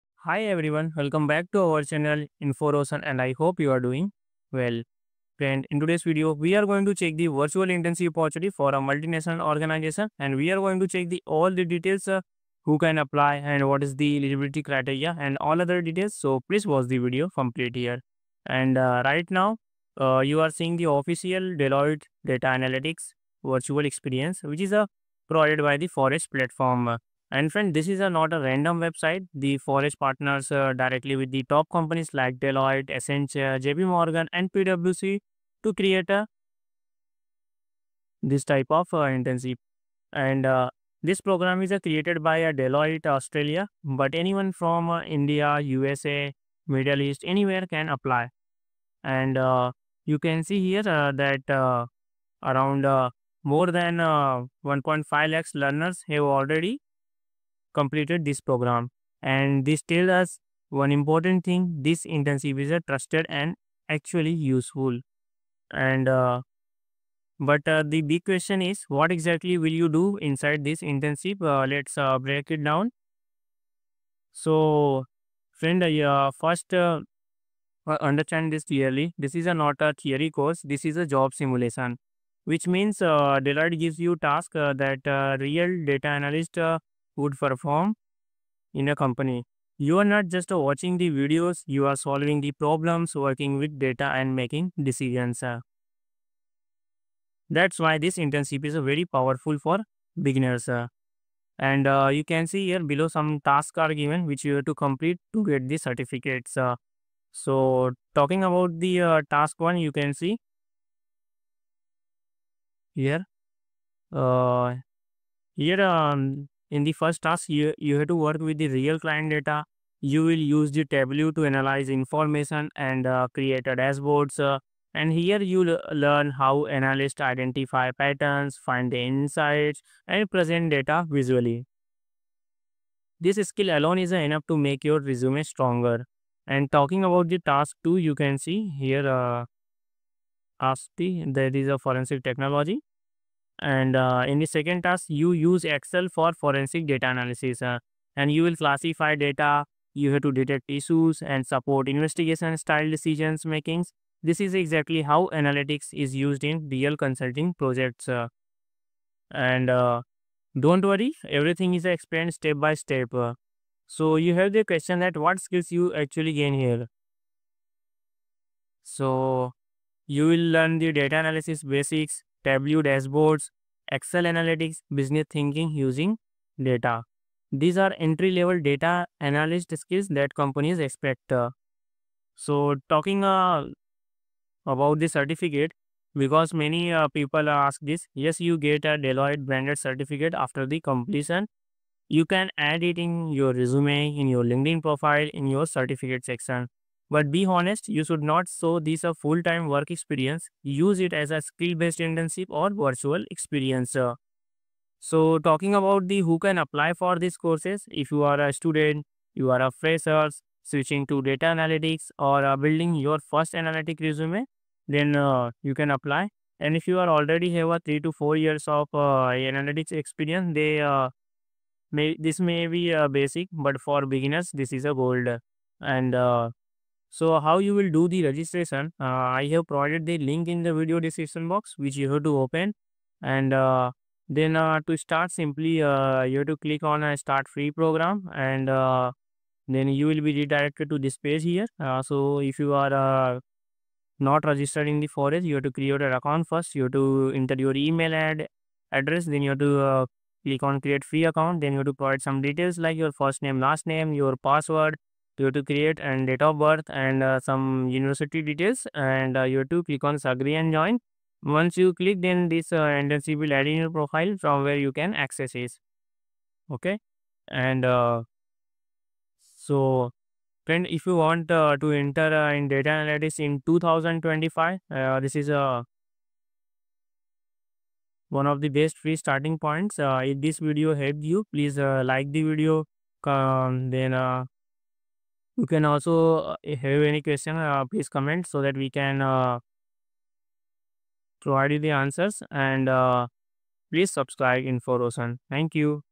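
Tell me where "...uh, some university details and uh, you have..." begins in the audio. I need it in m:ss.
4:17.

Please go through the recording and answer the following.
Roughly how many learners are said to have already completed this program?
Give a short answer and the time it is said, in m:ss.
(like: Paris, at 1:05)
1.5 lakhs, at 0:53.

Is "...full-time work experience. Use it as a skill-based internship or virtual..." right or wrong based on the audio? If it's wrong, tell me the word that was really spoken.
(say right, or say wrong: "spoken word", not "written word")
right.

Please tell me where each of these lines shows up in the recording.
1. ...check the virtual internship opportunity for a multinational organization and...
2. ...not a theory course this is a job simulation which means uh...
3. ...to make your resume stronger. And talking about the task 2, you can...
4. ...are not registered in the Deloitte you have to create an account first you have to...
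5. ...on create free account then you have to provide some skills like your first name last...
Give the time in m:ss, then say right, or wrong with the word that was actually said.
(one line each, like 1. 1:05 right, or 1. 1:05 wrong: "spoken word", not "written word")
1. 0:06 right
2. 1:19 right
3. 2:14 right
4. 4:02 wrong: "Forage", not "Deloitte"
5. 4:10 wrong: "details", not "skills".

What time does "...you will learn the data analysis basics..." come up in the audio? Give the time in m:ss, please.
2:50.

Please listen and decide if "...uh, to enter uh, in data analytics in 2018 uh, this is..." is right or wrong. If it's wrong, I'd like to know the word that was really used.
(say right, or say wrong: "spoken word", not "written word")
wrong: "2025", not "2018".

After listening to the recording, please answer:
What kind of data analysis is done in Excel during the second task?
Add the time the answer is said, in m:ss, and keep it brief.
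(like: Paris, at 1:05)
Forensic data analysis, at 2:26.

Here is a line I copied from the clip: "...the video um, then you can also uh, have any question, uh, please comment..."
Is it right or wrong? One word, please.
right.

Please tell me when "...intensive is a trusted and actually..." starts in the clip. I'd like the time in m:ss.
1:02.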